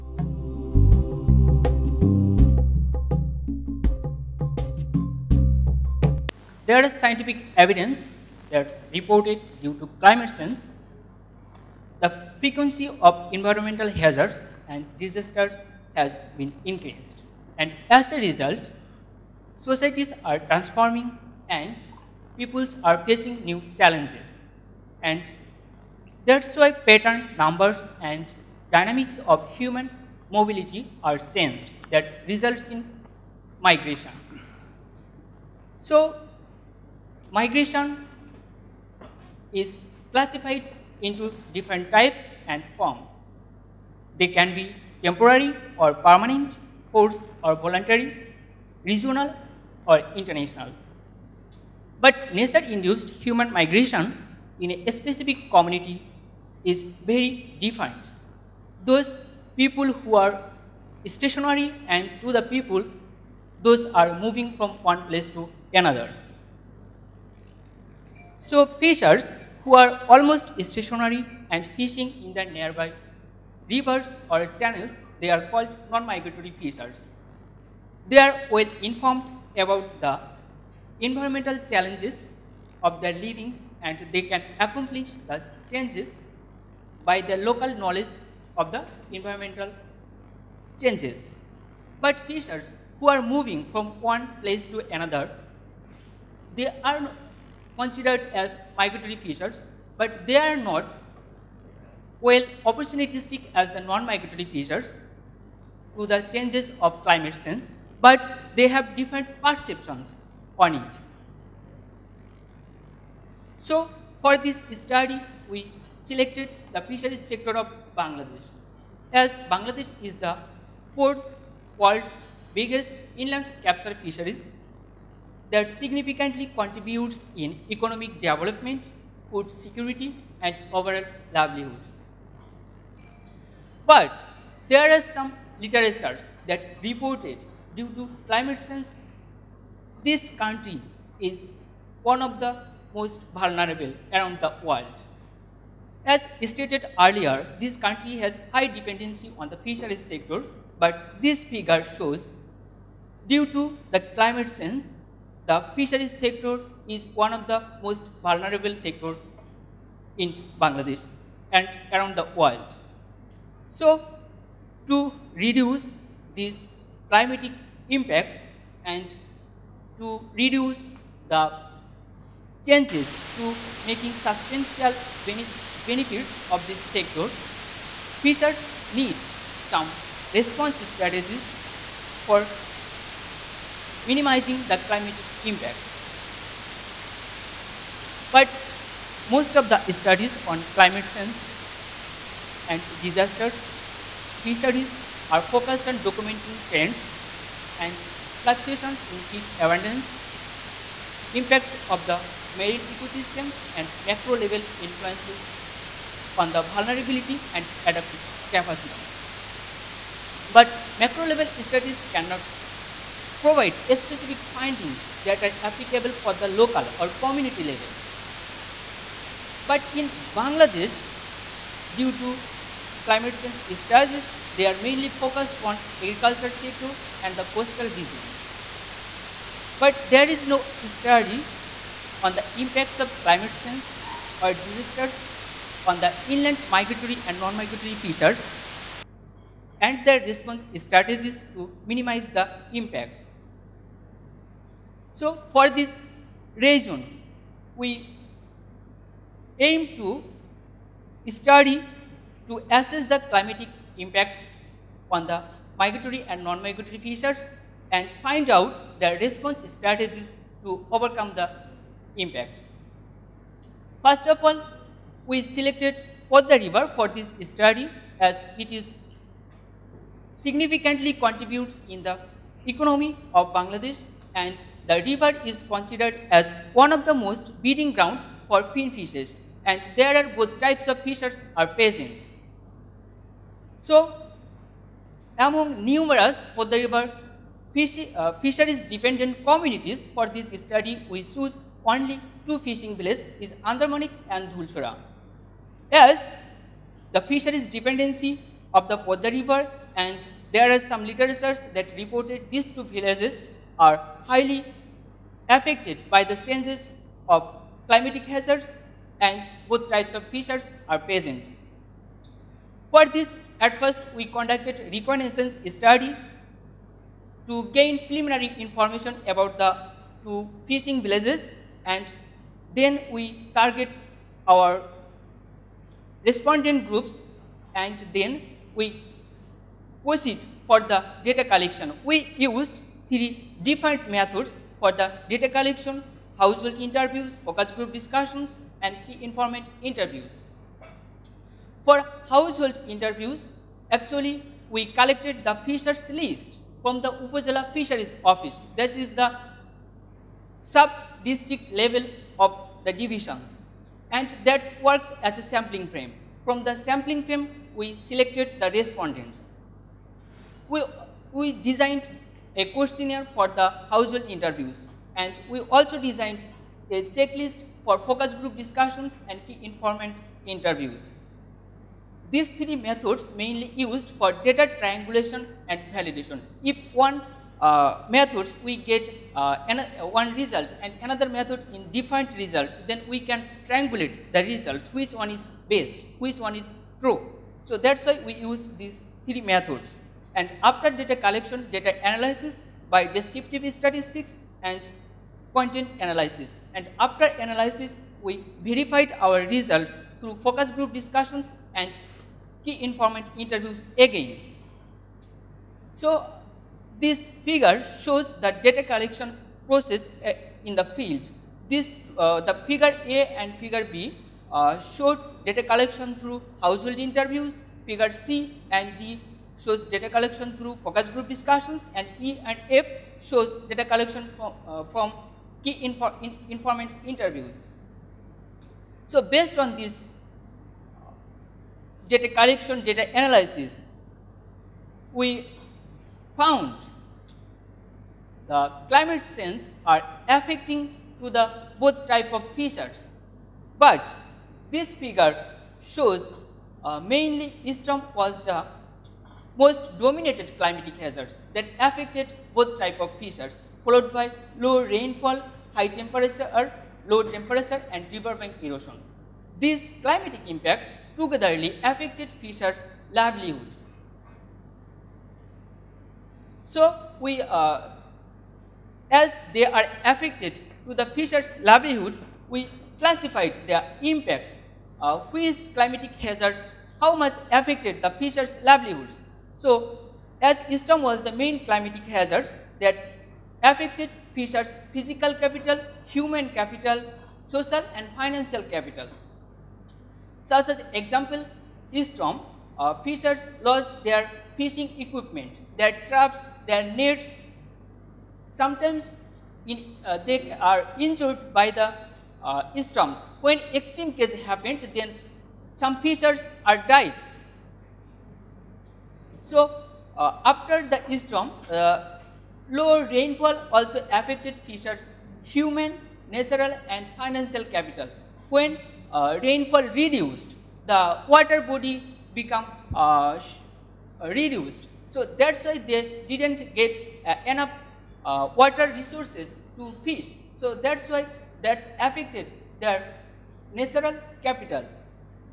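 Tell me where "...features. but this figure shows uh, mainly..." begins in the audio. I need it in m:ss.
7:22.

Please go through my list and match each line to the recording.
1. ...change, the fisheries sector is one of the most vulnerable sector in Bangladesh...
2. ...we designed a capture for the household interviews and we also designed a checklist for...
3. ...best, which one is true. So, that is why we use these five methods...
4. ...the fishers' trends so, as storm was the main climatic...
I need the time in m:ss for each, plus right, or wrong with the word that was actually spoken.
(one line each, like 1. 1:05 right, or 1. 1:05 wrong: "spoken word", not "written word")
1. 2:34 right
2. 6:01 wrong: "questionnaire", not "capture"
3. 6:25 wrong: "three", not "five"
4. 7:58 wrong: "livelihoods", not "trends".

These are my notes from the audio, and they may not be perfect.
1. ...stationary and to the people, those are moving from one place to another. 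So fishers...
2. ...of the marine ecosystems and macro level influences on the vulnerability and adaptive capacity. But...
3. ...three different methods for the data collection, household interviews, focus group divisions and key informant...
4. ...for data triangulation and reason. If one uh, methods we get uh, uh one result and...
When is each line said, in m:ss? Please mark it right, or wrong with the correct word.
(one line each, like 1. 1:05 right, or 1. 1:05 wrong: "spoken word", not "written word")
1. 1:01 right
2. 3:21 right
3. 5:33 wrong: "discussions", not "divisions"
4. 6:14 wrong: "validation", not "reason".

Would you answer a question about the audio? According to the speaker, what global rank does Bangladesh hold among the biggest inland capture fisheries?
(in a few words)
fourth.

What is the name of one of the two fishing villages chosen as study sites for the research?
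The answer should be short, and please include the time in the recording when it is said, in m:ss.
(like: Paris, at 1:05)
Andarmanik, at 4:53.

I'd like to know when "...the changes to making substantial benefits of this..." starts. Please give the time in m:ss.
2:51.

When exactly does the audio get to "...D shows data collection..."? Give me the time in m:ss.
6:58.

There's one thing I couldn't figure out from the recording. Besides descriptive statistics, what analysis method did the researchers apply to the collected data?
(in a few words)
content analysis.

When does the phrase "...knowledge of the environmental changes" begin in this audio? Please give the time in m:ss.
1:27.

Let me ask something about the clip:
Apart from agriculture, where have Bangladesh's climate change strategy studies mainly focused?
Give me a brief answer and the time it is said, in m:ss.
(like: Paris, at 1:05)
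coastal regions, at 3:47.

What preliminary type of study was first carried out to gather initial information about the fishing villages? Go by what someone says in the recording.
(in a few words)
reconnaissance study.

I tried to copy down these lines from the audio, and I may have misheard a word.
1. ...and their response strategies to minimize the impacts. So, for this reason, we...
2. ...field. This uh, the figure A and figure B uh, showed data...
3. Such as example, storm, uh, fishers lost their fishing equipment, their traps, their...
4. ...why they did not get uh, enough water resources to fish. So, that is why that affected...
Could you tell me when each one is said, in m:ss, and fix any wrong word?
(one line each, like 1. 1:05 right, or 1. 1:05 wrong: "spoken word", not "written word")
1. 3:59 right
2. 6:50 right
3. 8:10 right
4. 8:45 right.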